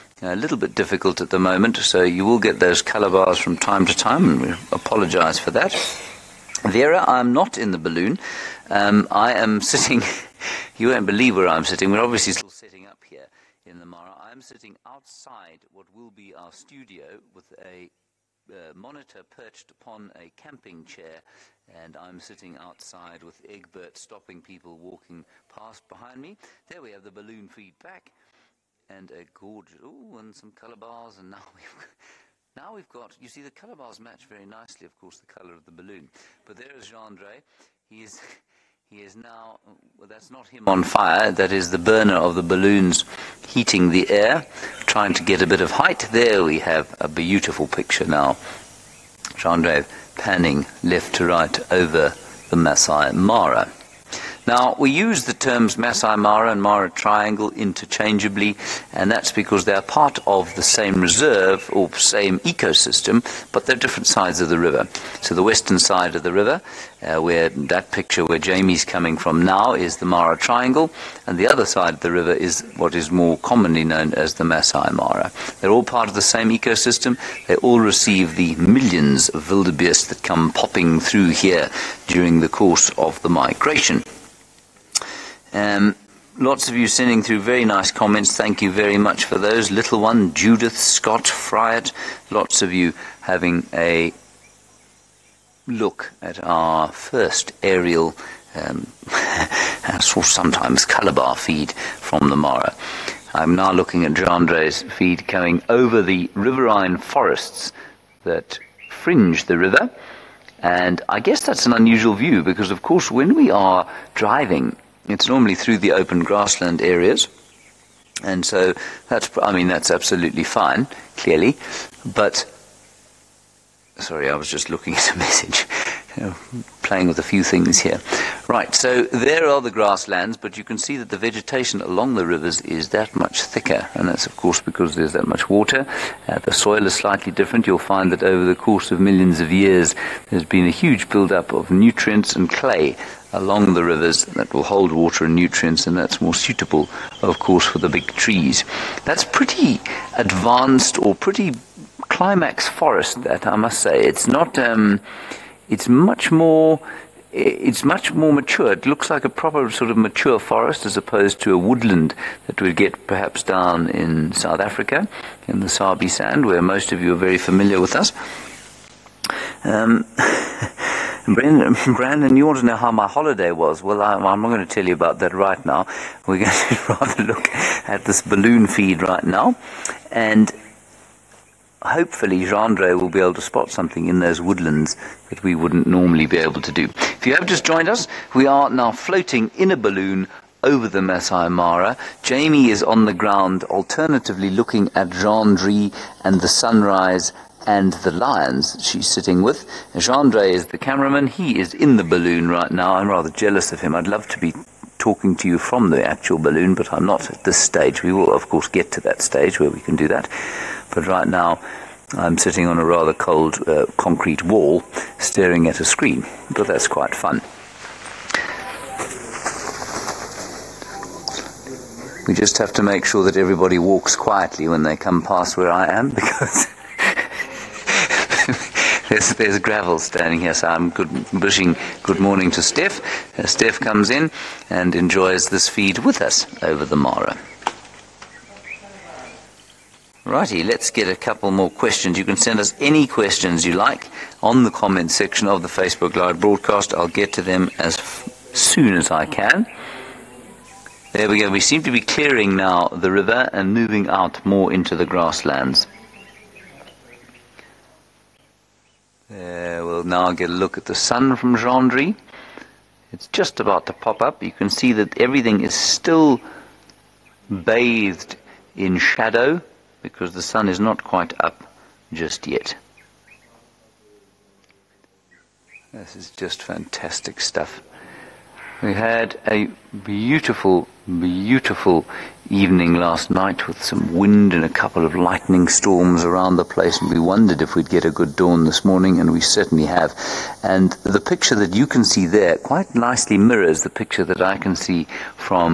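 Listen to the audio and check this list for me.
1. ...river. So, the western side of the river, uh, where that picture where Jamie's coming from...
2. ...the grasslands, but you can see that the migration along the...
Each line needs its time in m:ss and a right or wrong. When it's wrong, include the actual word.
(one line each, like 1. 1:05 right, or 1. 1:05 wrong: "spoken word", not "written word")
1. 1:04 right
2. 2:09 wrong: "vegetation", not "migration".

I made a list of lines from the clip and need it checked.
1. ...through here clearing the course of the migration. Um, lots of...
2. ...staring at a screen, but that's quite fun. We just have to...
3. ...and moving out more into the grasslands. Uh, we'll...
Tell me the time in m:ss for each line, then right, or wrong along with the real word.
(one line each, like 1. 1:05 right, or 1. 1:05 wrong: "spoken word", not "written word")
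1. 1:20 wrong: "during", not "clearing"
2. 3:35 right
3. 4:13 right.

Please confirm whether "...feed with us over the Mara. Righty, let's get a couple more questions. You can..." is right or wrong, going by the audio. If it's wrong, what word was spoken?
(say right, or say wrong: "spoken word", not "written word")
right.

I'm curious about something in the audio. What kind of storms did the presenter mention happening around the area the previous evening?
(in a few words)
Lightning storms.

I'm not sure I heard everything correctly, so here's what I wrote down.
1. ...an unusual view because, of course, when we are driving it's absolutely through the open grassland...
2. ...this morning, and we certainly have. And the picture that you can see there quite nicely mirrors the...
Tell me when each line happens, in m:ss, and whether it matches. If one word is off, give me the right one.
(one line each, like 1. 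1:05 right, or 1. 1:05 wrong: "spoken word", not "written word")
1. 1:51 wrong: "normally", not "absolutely"
2. 4:48 right.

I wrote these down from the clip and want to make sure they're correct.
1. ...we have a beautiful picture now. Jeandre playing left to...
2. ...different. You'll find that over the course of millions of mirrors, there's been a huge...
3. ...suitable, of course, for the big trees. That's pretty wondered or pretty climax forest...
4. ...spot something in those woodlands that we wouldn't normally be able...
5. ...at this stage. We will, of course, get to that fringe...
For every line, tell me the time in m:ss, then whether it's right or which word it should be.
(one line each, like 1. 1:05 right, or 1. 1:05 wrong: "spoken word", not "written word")
1. 0:46 wrong: "panning", not "playing"
2. 2:17 wrong: "years", not "mirrors"
3. 2:26 wrong: "advanced", not "wondered"
4. 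3:03 right
5. 3:27 wrong: "stage", not "fringe".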